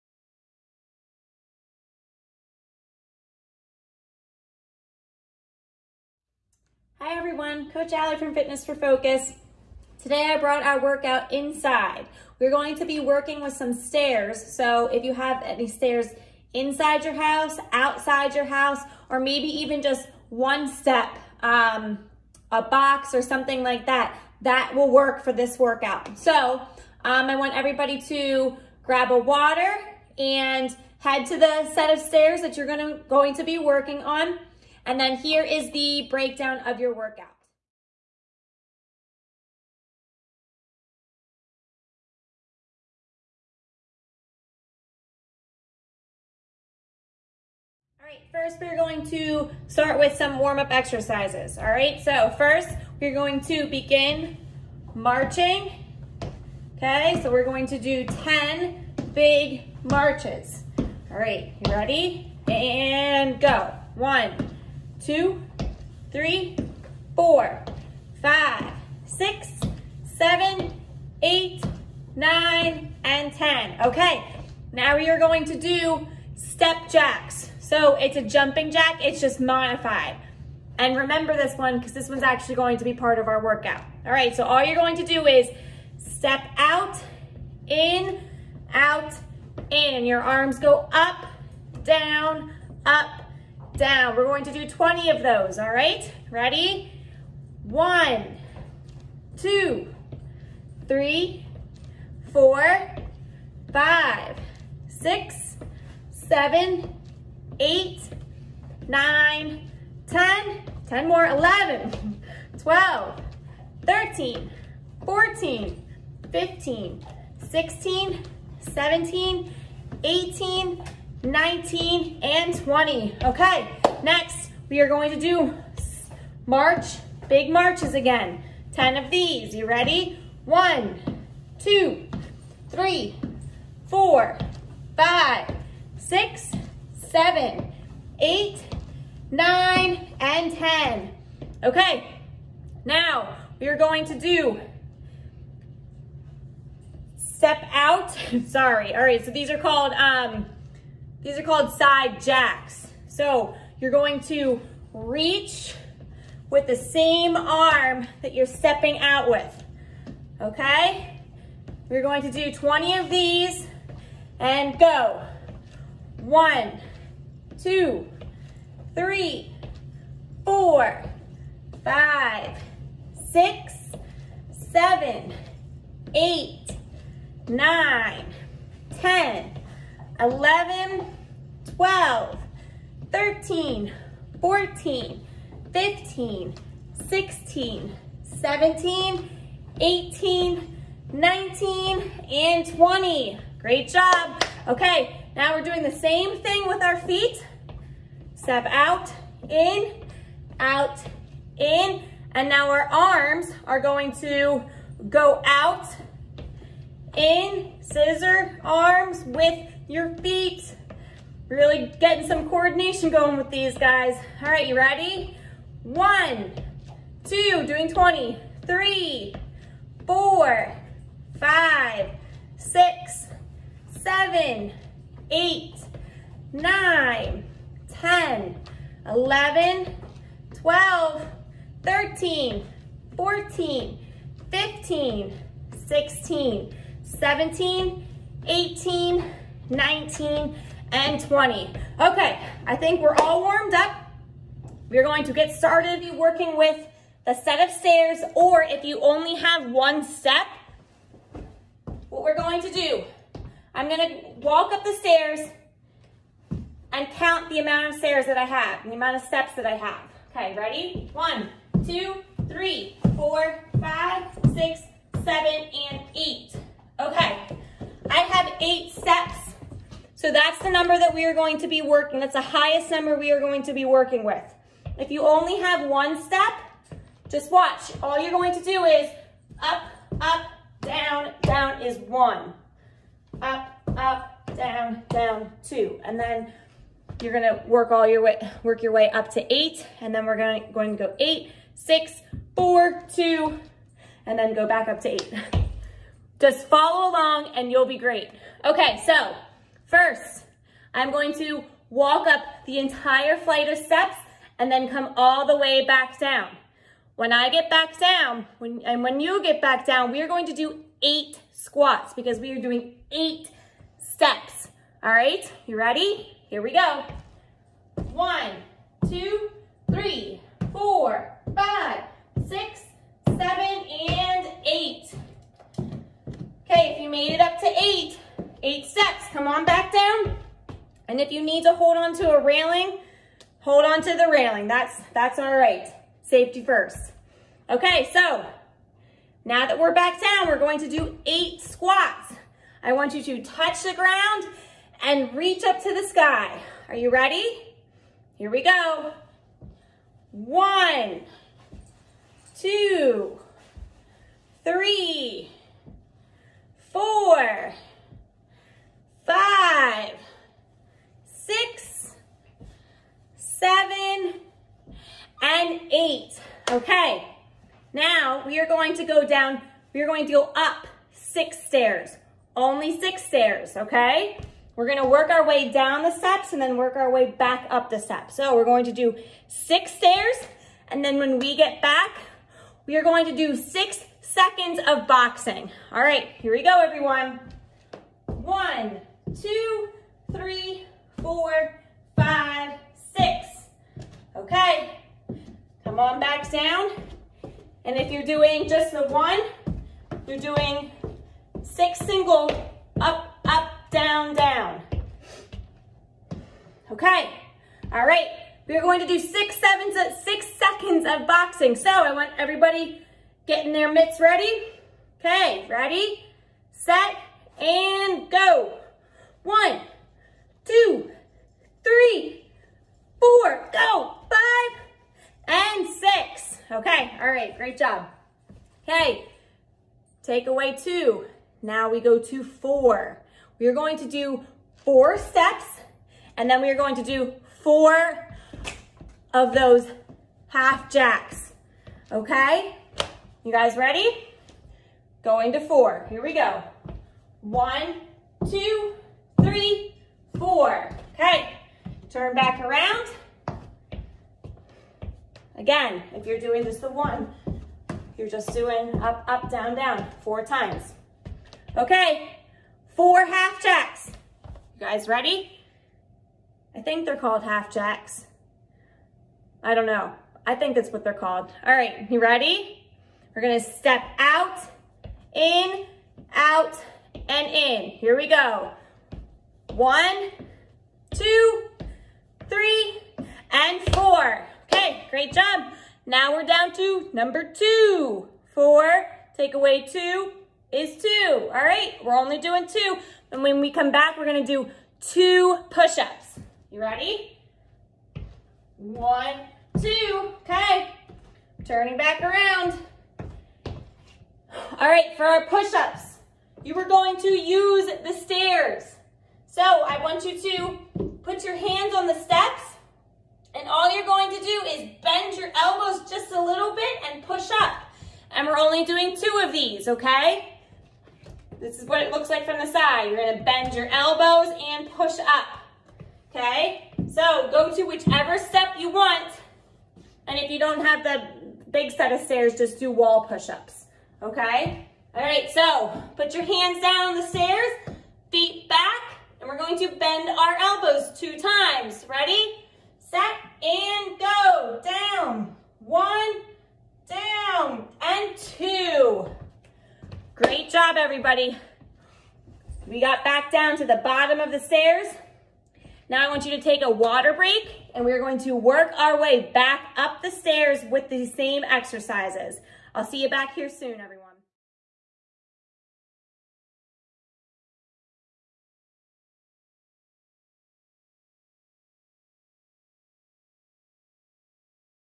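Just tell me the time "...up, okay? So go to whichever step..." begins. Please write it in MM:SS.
08:45.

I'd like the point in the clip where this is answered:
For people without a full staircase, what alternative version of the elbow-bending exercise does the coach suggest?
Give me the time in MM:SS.
08:52.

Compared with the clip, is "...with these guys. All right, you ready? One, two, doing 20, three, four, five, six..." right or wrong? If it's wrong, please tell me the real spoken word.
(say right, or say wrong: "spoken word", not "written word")
right.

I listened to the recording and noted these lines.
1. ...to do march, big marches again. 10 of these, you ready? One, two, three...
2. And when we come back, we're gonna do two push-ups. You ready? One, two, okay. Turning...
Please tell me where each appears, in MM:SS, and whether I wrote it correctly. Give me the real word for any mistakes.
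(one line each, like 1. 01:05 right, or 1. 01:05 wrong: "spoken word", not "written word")
1. 02:05 right
2. 08:13 right.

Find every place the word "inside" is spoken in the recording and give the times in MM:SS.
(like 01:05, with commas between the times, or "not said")
00:11, 00:16.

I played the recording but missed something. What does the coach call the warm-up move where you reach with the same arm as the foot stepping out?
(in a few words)
side jacks.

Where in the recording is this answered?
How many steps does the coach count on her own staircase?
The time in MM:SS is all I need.
04:28.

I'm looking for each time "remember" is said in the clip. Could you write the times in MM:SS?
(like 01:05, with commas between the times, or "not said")
01:20.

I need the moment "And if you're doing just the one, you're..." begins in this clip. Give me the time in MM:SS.
06:37.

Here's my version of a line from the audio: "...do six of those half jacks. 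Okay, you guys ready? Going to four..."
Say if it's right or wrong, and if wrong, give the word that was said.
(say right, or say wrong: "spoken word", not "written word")
wrong: "four", not "six".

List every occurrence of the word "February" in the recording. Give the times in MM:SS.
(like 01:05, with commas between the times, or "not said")
not said.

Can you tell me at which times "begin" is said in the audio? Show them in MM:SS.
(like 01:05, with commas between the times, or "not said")
00:53.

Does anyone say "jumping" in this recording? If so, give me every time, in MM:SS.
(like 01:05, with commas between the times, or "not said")
01:18.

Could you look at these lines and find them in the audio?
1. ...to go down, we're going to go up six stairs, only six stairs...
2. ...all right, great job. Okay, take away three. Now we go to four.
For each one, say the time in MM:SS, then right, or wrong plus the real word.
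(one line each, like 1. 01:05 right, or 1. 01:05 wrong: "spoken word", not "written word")
1. 06:08 right
2. 07:07 wrong: "two", not "three".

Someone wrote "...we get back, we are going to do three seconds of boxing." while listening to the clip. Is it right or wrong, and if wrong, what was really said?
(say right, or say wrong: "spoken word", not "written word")
wrong: "six", not "three".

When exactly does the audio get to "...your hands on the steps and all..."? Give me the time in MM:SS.
08:31.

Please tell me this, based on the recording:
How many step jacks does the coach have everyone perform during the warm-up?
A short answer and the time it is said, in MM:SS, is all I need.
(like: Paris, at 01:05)
20, at 01:34.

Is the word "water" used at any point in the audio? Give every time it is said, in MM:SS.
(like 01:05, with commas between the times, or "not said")
00:29, 09:16.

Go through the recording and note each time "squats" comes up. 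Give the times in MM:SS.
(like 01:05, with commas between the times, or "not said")
05:11, 05:41.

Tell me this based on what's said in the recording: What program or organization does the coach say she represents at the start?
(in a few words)
Fitness for Focus.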